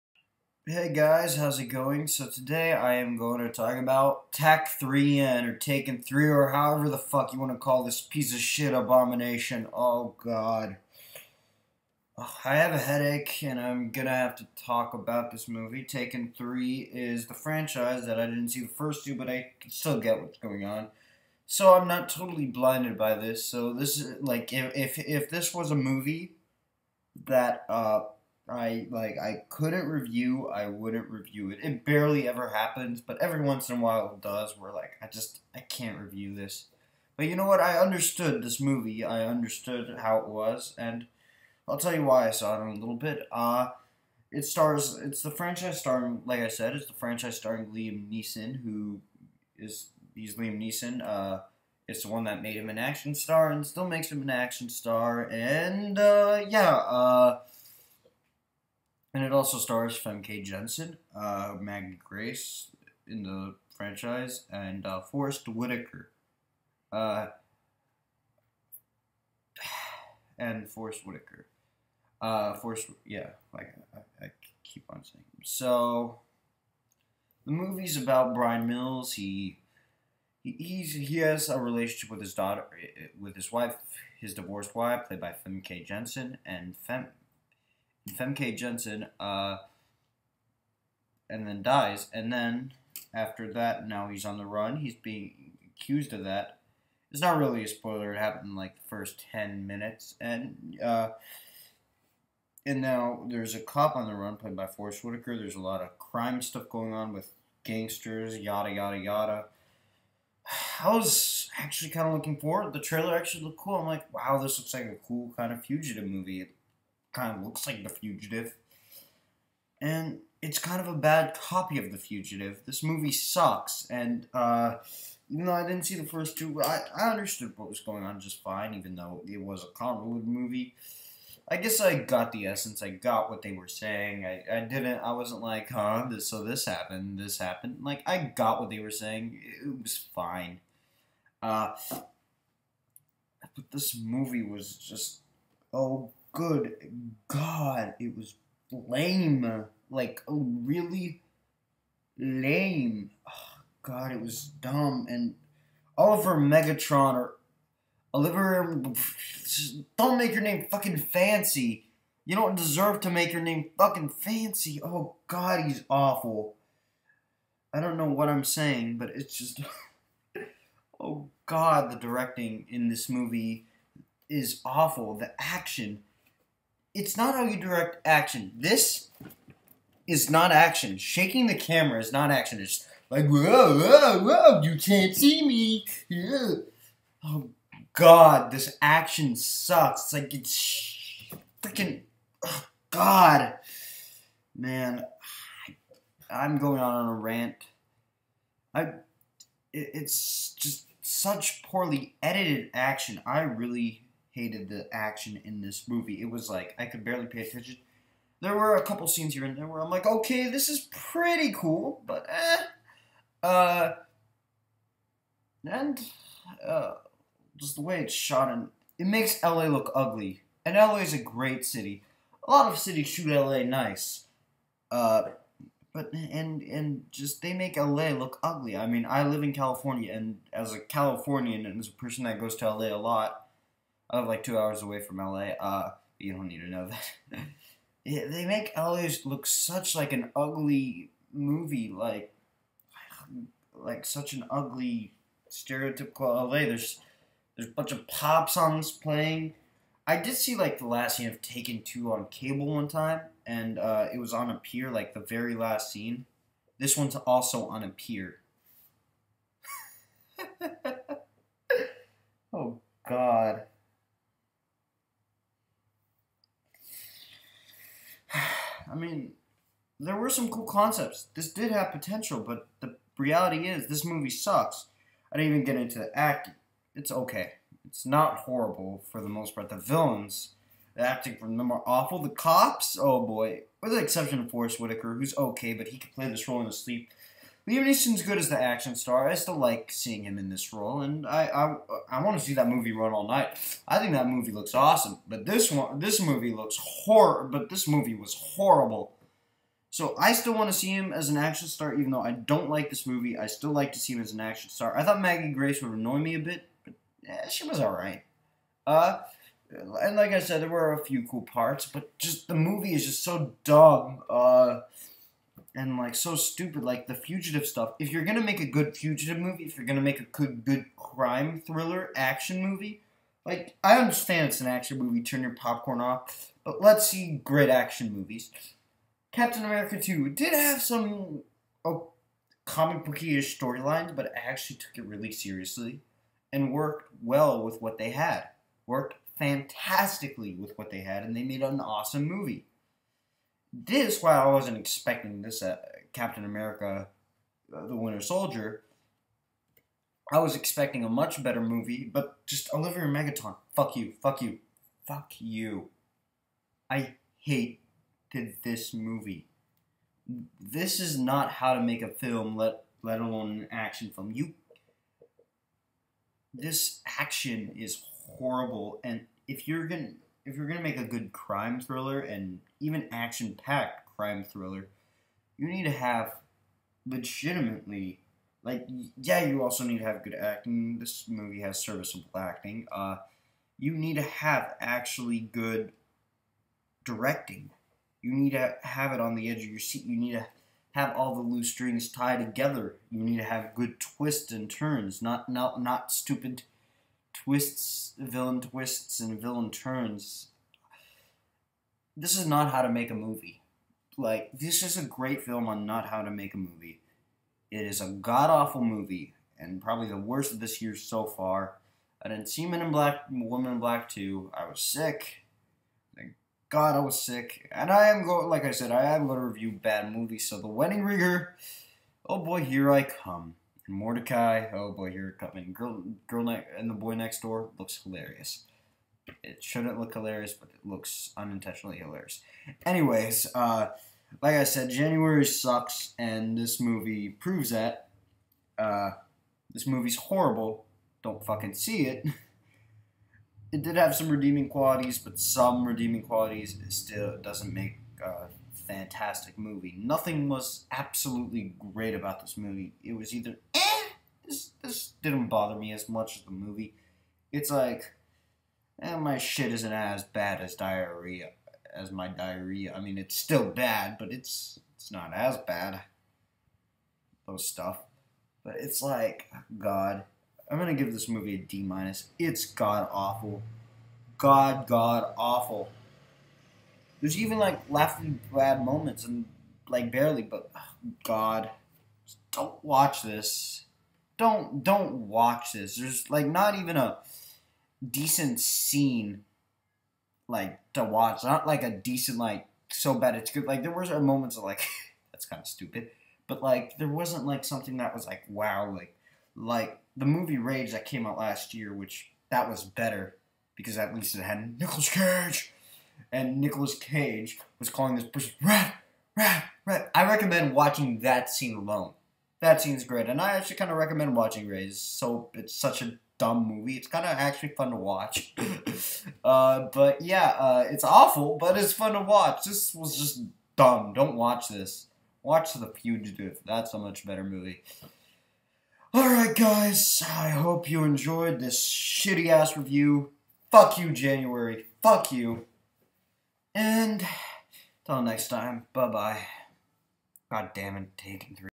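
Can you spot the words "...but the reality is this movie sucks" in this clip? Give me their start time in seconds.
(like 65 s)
272 s.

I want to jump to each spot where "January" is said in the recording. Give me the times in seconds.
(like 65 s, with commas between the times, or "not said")
434 s, 534 s.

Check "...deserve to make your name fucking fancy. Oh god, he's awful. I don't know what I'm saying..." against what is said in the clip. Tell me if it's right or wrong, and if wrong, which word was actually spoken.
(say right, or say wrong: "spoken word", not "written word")
right.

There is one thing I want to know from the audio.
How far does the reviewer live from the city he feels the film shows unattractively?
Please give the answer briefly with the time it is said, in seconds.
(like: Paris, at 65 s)
2 hours, at 234 s.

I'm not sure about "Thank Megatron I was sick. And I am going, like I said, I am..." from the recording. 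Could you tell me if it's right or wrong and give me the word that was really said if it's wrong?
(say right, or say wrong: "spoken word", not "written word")
wrong: "God", not "Megatron".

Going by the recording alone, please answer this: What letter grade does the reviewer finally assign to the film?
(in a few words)
D minus.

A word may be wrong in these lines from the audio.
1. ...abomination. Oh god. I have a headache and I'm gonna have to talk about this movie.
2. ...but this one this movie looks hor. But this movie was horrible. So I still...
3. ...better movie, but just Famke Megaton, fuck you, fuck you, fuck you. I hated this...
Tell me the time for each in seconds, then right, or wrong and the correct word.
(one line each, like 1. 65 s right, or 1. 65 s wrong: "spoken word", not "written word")
1. 8 s right
2. 295 s right
3. 351 s wrong: "Olivier", not "Famke".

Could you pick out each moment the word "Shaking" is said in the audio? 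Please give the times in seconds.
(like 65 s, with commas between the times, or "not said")
180 s.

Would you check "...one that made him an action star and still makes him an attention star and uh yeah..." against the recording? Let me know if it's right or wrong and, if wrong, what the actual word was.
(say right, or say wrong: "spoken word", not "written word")
wrong: "action", not "attention".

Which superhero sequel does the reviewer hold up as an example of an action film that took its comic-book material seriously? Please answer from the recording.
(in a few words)
Captain America 2.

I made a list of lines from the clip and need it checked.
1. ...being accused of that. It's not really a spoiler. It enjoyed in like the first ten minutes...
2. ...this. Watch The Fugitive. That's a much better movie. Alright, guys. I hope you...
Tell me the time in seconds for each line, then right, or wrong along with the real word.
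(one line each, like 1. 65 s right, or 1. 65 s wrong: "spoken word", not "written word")
1. 94 s wrong: "happened", not "enjoyed"
2. 524 s right.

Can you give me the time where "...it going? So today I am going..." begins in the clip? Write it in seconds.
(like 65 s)
1 s.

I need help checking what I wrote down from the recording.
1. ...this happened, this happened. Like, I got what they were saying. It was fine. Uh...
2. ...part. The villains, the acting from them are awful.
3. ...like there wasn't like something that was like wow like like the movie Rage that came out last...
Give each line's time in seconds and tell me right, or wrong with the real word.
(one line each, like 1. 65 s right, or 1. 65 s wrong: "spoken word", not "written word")
1. 136 s right
2. 279 s right
3. 496 s right.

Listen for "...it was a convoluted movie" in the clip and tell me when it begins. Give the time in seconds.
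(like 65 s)
129 s.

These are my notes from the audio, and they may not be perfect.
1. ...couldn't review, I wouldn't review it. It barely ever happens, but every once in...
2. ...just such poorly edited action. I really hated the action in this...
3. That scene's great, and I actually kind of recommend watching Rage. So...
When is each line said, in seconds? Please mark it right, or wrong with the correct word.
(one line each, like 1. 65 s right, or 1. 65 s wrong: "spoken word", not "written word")
1. 29 s right
2. 200 s right
3. 512 s right.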